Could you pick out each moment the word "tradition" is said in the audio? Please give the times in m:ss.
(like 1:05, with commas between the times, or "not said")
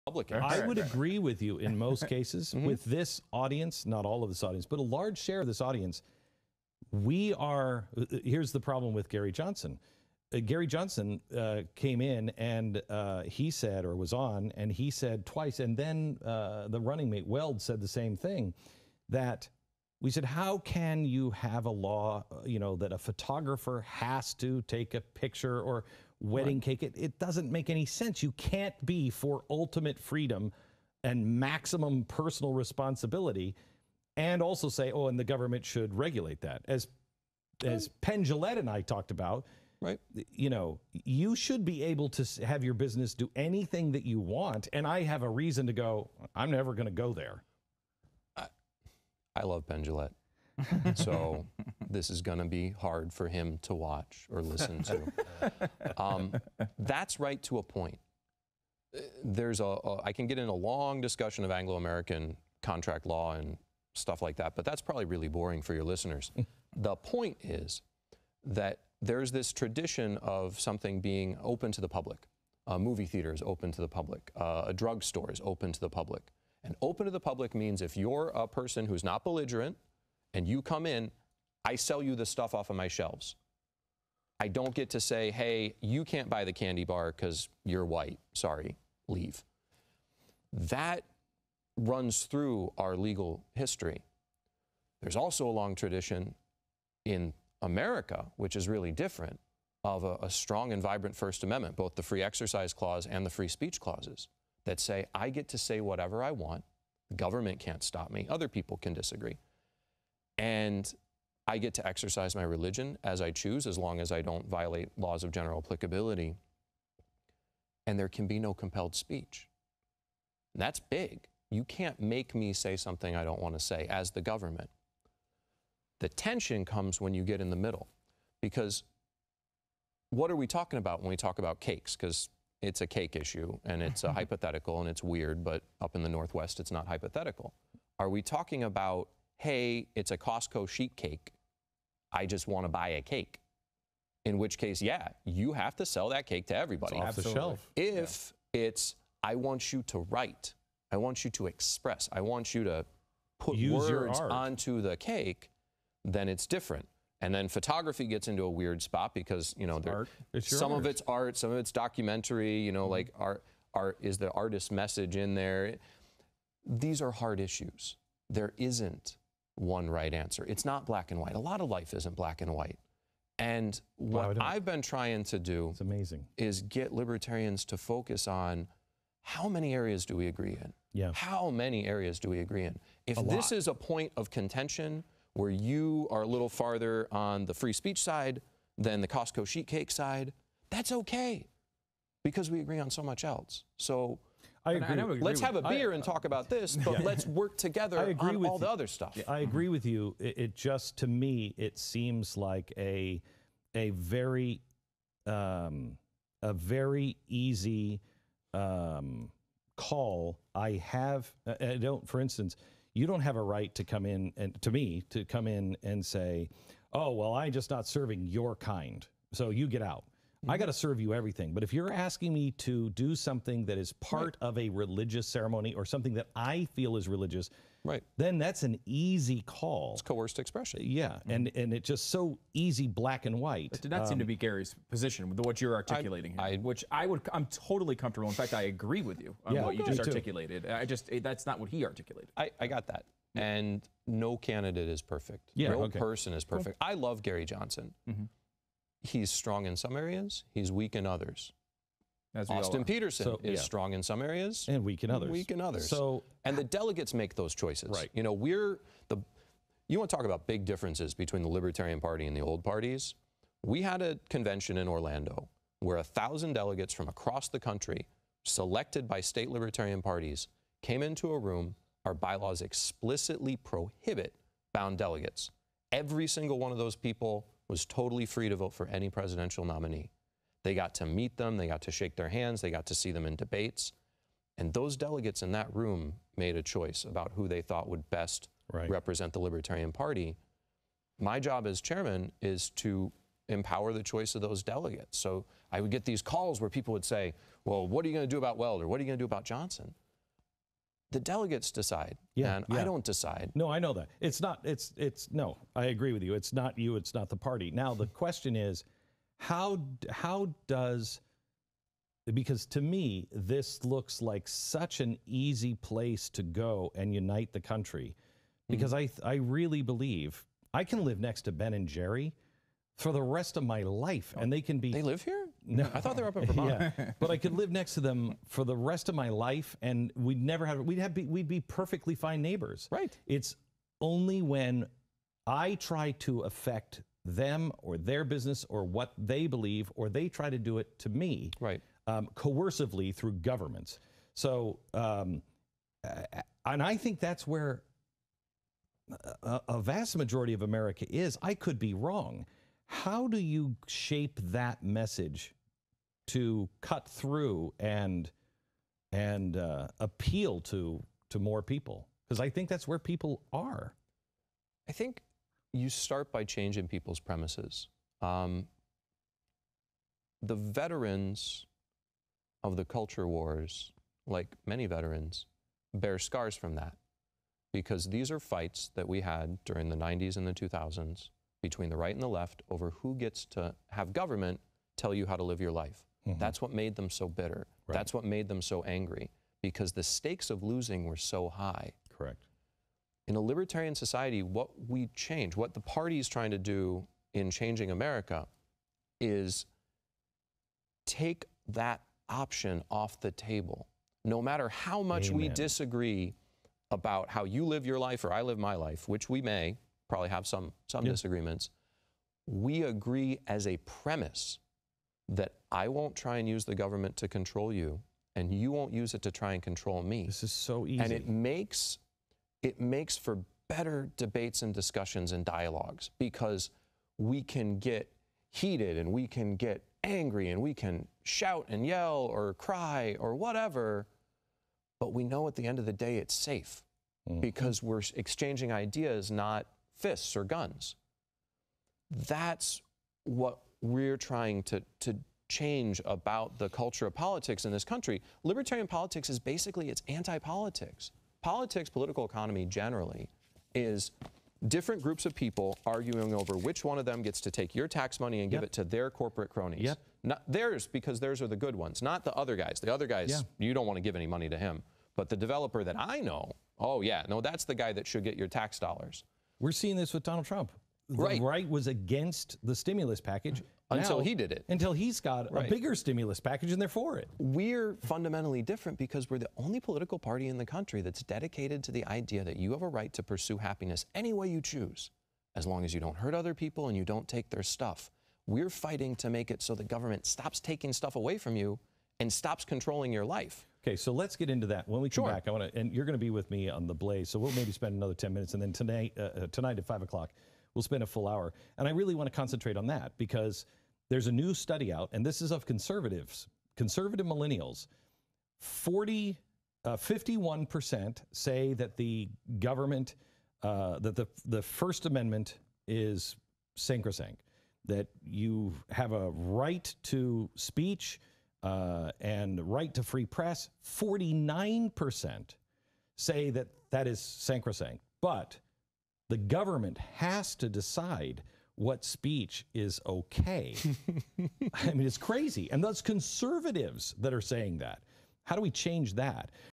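1:09, 1:35.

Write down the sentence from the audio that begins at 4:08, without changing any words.
Mm-hmm he's strong in some areas, he's weak in others.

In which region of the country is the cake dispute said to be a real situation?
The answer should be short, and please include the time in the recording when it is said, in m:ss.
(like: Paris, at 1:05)
the Northwest, at 2:16.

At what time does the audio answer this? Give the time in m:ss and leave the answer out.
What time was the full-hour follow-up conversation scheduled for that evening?
8:19.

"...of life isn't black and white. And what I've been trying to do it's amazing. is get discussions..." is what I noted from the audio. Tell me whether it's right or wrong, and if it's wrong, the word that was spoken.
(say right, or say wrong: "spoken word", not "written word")
wrong: "libertarians", not "discussions".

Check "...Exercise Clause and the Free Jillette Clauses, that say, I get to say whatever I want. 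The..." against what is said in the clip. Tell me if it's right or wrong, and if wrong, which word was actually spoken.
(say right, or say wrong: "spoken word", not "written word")
wrong: "Speech", not "Jillette".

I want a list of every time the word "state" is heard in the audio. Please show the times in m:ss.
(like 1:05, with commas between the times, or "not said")
4:29.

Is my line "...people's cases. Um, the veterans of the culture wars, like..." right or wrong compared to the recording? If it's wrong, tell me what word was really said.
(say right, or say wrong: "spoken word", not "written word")
wrong: "premises", not "cases".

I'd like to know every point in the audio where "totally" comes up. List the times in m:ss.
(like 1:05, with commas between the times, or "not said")
3:57, 4:37.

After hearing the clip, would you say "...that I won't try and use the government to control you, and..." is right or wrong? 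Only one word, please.
right.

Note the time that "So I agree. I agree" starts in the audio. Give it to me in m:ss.
3:13.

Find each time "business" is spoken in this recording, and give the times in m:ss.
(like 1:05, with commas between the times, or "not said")
0:42, 5:38.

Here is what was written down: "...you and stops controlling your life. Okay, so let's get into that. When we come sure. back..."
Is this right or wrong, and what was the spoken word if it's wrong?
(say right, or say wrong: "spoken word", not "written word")
right.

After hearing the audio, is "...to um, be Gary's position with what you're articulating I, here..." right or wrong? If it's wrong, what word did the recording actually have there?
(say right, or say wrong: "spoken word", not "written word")
right.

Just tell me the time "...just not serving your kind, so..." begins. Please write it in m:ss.
3:37.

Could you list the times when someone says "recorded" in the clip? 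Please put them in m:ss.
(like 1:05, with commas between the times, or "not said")
not said.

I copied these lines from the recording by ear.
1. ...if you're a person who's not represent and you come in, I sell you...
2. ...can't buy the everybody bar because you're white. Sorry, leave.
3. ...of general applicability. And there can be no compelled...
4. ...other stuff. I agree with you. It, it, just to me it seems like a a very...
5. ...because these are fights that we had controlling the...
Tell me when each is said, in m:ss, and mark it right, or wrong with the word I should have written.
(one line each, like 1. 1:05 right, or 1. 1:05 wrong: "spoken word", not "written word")
1. 1:17 wrong: "belligerent", not "represent"
2. 1:26 wrong: "candy", not "everybody"
3. 1:55 right
4. 3:18 right
5. 6:17 wrong: "during", not "controlling".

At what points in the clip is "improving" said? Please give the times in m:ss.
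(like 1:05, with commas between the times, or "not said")
not said.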